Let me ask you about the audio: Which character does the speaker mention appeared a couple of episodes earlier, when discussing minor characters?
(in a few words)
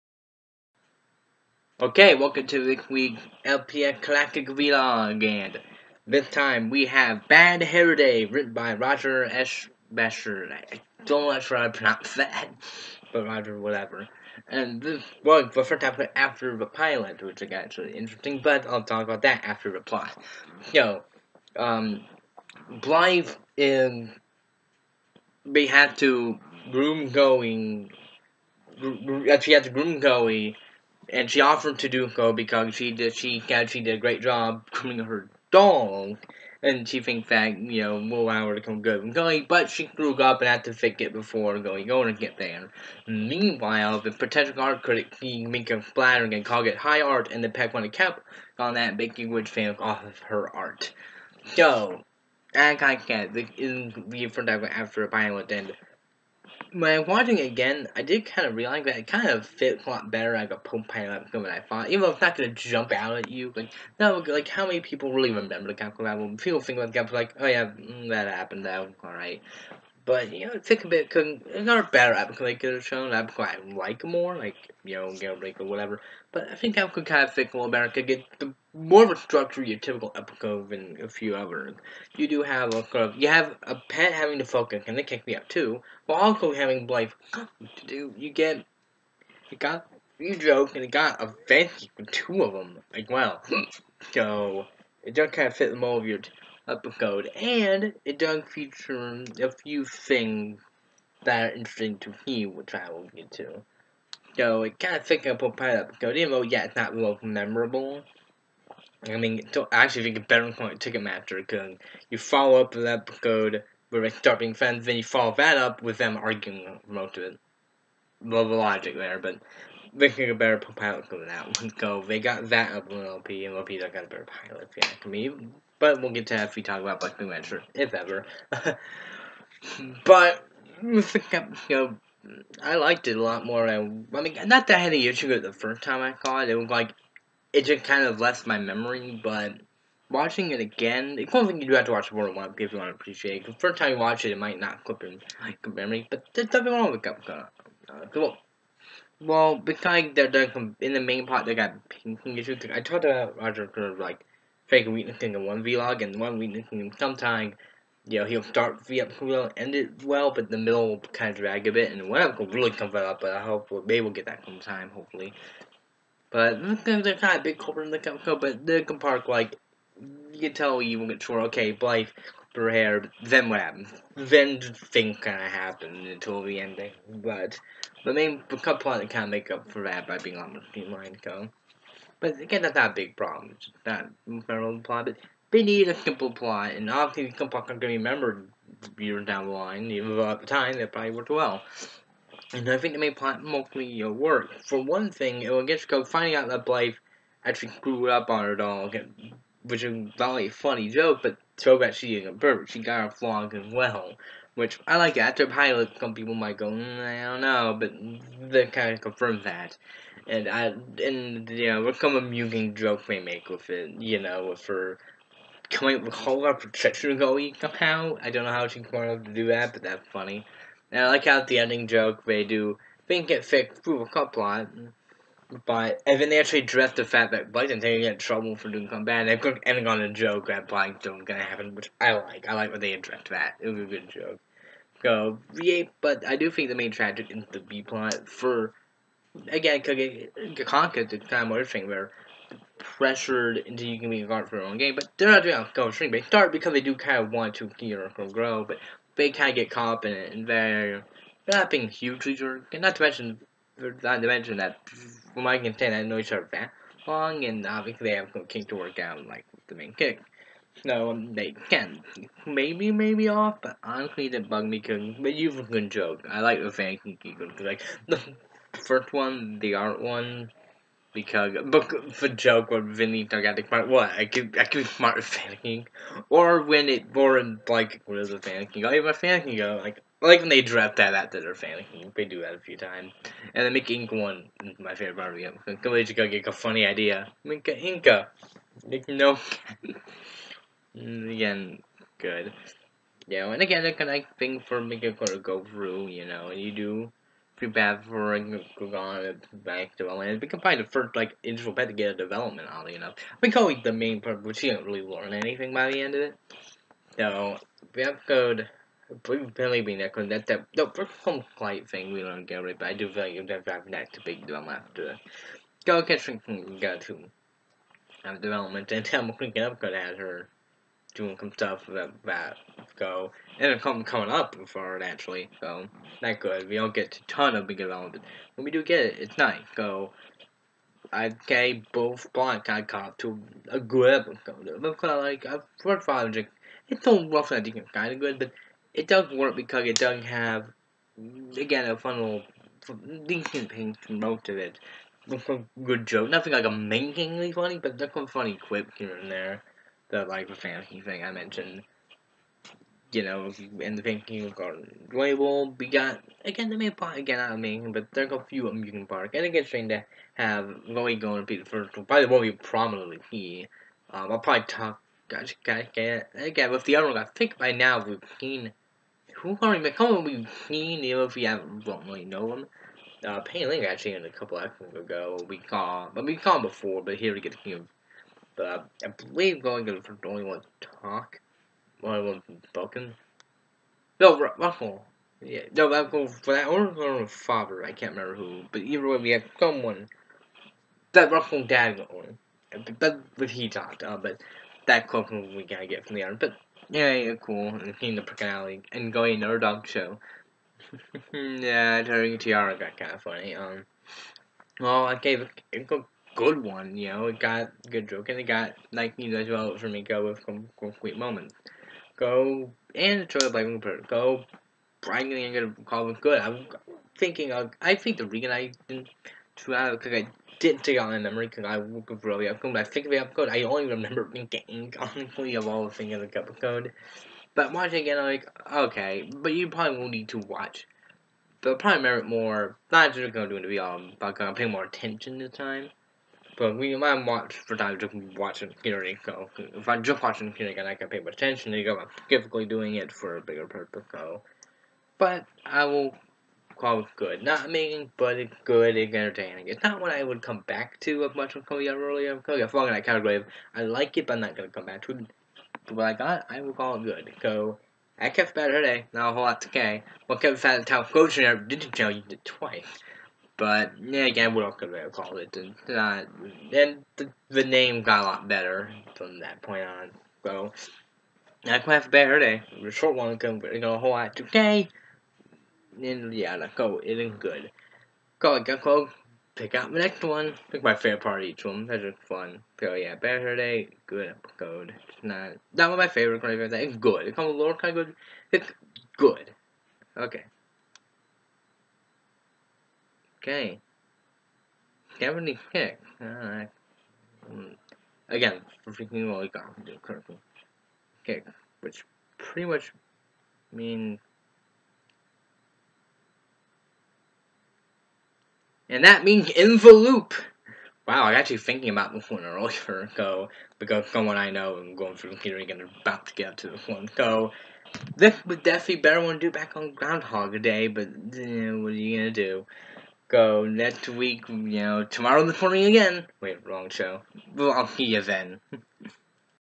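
Penny Ling.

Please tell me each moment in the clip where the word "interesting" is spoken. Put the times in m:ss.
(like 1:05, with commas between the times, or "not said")
0:17, 1:41.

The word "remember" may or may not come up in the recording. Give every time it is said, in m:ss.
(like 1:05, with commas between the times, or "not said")
1:05, 3:07, 6:28, 7:03.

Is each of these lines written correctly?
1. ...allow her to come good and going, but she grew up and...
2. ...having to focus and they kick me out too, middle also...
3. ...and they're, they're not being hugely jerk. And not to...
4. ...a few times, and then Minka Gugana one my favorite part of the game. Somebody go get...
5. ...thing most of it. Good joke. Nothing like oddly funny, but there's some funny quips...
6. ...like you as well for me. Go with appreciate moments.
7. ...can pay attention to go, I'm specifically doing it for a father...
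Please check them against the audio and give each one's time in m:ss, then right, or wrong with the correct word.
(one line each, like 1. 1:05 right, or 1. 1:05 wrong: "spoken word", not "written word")
1. 0:38 right
2. 1:24 wrong: "while", not "middle"
3. 4:10 right
4. 4:42 wrong: "Inca", not "Gugana"
5. 5:43 wrong: "amazingly", not "oddly"
6. 6:48 wrong: "complete", not "appreciate"
7. 7:20 wrong: "bigger", not "father".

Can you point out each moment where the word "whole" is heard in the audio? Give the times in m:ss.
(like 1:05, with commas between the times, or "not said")
3:36, 7:39, 7:53.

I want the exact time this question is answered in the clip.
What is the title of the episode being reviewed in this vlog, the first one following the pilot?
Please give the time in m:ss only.
0:07.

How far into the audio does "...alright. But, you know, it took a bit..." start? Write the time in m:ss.
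1:09.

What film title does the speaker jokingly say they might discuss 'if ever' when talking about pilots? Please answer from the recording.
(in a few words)
Black Panther.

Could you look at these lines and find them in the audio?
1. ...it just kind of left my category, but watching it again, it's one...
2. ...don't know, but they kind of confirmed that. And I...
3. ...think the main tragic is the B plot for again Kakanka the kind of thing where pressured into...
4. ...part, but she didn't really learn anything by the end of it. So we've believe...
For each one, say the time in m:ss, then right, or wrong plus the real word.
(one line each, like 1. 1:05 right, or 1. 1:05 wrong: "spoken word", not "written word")
1. 2:17 wrong: "memory", not "category"
2. 3:27 right
3. 3:56 right
4. 5:04 right.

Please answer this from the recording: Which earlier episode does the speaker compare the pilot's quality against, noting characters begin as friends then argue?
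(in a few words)
Ticketmaster.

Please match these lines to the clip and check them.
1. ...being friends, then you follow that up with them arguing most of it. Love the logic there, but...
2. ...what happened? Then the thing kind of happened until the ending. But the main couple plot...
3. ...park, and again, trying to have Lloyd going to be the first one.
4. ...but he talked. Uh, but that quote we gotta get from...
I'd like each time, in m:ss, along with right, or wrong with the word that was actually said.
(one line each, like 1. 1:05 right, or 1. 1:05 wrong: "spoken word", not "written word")
1. 1:54 right
2. 2:53 right
3. 5:59 right
4. 6:33 right.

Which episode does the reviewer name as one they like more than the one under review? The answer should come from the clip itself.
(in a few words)
Gale Breaker.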